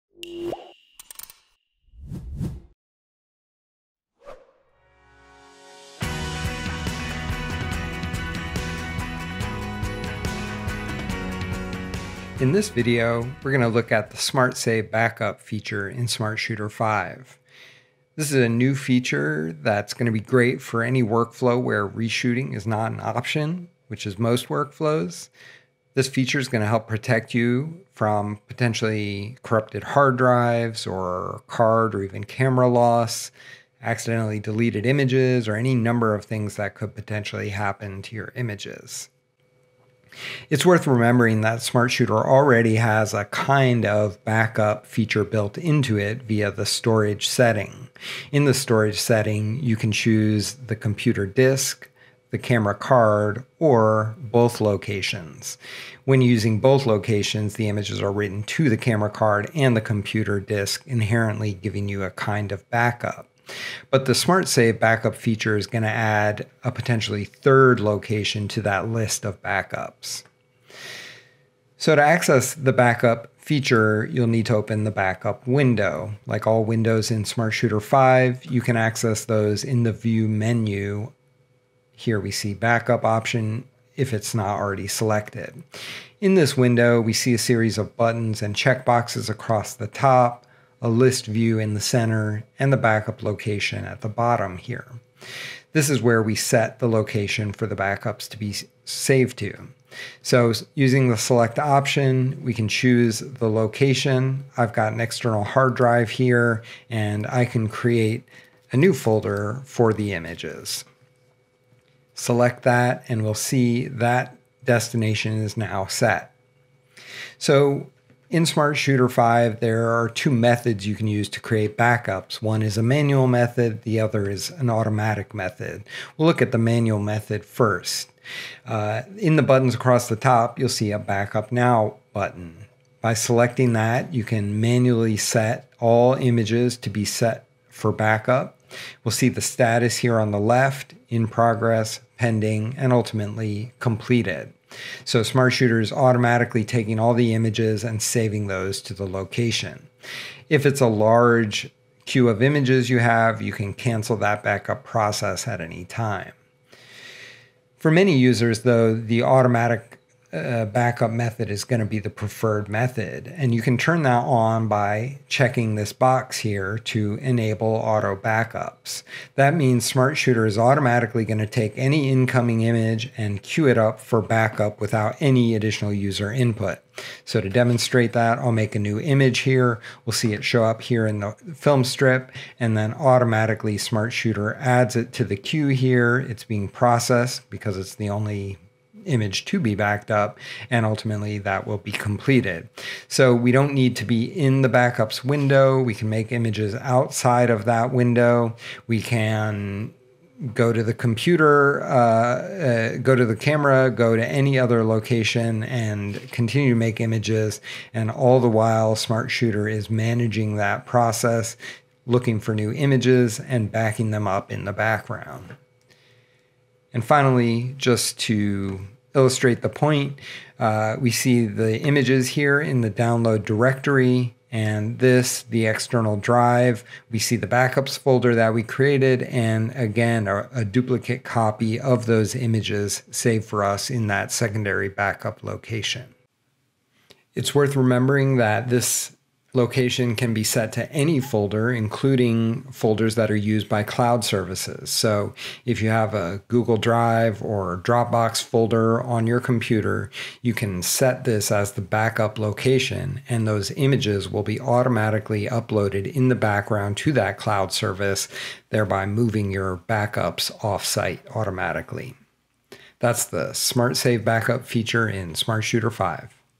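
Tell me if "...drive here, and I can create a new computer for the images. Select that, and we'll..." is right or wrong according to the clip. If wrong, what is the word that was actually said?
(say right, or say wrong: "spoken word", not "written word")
wrong: "folder", not "computer".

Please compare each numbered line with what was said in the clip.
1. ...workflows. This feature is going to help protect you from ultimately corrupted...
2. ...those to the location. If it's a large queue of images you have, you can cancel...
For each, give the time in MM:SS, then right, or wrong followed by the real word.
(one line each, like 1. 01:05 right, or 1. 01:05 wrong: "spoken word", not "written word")
1. 00:24 wrong: "potentially", not "ultimately"
2. 02:28 right.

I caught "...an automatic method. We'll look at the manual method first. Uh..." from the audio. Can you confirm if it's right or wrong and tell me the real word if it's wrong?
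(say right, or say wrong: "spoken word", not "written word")
right.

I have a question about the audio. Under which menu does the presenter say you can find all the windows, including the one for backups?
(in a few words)
View menu.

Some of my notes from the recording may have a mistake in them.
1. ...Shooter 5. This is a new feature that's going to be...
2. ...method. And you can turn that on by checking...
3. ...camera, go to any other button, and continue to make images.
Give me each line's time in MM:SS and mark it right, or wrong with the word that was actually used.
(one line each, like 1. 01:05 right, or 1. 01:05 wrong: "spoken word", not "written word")
1. 00:16 right
2. 02:42 right
3. 03:23 wrong: "location", not "button".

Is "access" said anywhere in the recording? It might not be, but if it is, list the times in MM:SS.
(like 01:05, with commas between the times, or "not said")
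01:12, 01:18.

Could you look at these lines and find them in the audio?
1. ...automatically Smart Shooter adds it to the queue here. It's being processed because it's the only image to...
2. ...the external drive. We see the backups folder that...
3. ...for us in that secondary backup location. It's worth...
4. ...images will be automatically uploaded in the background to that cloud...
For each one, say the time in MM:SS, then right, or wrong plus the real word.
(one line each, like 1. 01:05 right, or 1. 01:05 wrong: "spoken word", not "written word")
1. 03:02 right
2. 03:45 right
3. 03:53 right
4. 04:13 right.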